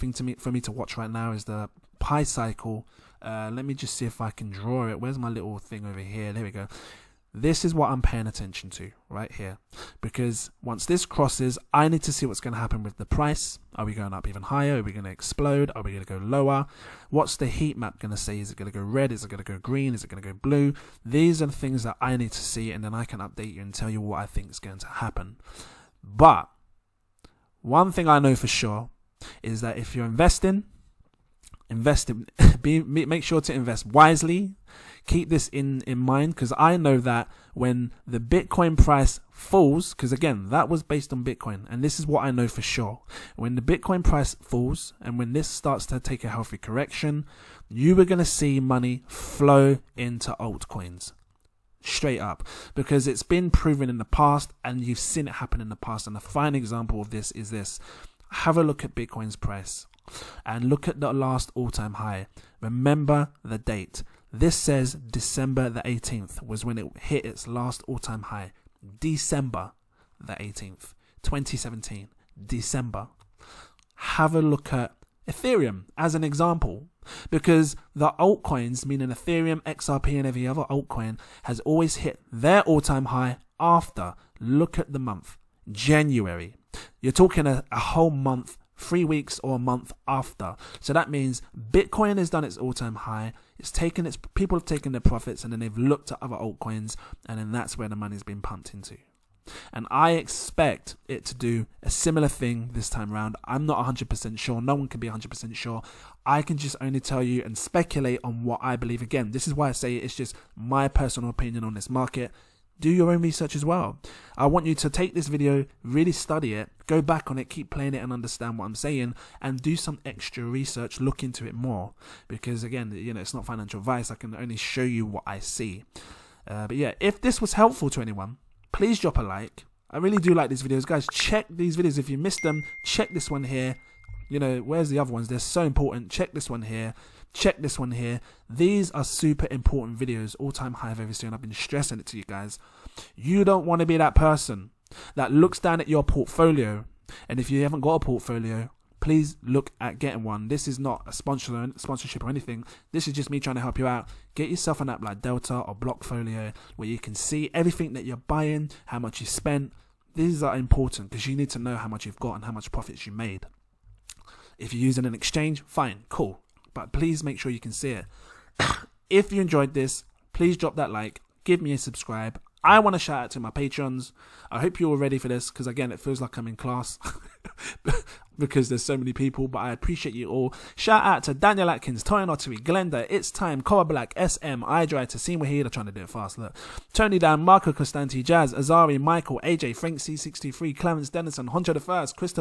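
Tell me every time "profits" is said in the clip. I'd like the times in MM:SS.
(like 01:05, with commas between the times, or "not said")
01:35, 02:42.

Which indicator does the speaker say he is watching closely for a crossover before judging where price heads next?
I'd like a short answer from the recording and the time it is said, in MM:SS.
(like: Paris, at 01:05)
Pi cycle, at 00:01.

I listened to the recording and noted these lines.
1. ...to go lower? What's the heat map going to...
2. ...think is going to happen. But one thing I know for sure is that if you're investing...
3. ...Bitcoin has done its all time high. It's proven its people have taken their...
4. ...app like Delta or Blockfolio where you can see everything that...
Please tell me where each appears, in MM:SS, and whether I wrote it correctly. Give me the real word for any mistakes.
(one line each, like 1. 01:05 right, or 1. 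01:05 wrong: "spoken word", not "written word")
1. 00:16 right
2. 00:24 right
3. 01:31 wrong: "taken", not "proven"
4. 02:34 right.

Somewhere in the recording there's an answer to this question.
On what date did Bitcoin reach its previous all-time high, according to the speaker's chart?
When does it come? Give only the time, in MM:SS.
01:08.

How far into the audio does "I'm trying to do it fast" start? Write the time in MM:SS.
03:05.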